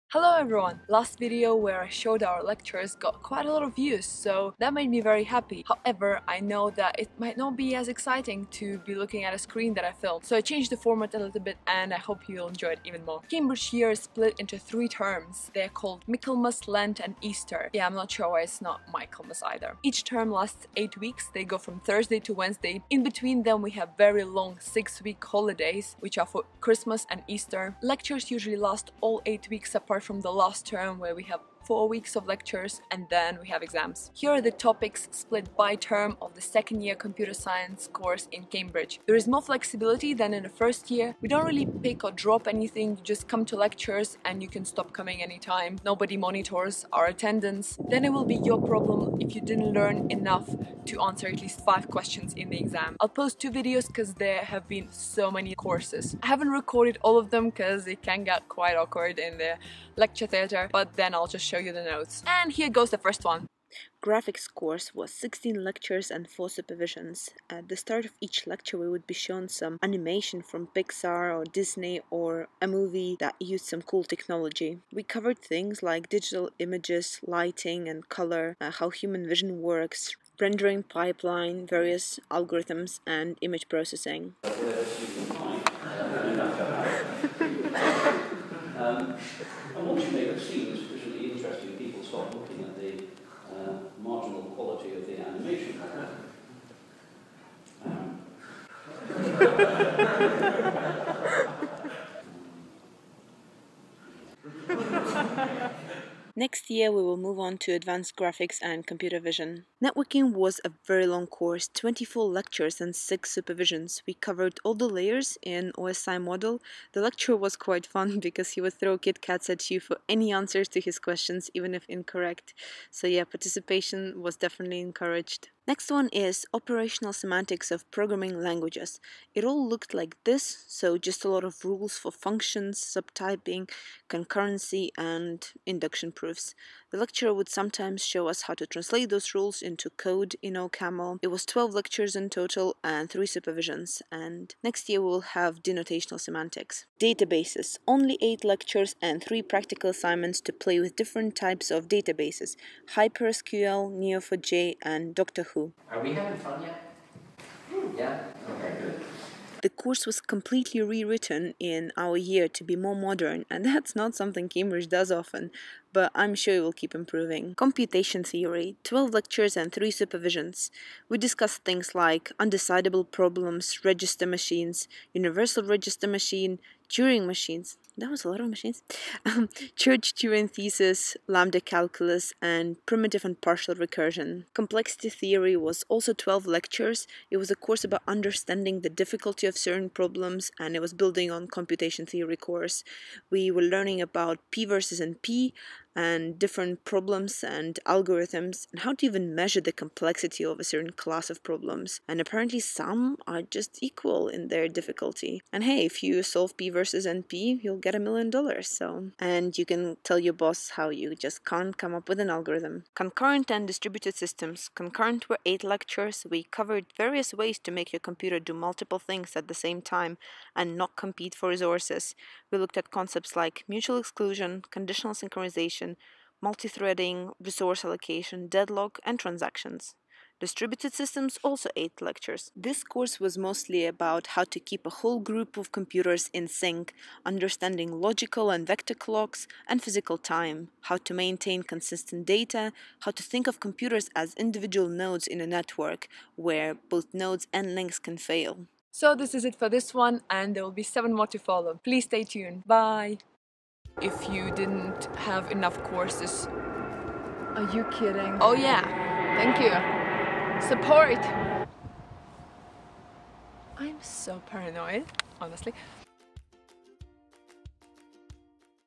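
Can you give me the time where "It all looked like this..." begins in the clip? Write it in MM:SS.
02:09.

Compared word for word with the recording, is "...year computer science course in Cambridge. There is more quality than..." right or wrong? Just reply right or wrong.
wrong.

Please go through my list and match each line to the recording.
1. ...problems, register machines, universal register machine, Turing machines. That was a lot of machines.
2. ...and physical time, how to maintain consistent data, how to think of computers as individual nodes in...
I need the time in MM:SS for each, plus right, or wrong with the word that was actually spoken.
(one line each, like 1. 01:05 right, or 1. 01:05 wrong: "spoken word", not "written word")
1. 02:53 right
2. 03:59 right.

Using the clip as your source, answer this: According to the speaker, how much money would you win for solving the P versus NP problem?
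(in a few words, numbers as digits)
a million dollars.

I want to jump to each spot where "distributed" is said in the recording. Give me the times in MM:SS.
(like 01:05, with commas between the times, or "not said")
03:33, 03:50.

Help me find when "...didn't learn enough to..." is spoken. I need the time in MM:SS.
00:49.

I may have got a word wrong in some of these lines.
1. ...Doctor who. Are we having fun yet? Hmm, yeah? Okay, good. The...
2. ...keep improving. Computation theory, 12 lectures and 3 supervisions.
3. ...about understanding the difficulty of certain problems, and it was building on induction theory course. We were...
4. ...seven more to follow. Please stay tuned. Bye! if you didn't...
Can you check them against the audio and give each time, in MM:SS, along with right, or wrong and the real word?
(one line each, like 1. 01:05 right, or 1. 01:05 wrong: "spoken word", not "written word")
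1. 02:35 right
2. 02:46 right
3. 03:07 wrong: "computation", not "induction"
4. 04:10 right.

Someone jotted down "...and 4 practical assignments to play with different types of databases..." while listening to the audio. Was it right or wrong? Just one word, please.
wrong.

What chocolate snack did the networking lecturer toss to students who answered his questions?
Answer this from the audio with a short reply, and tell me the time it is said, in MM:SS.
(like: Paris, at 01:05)
Kit Kats, at 01:58.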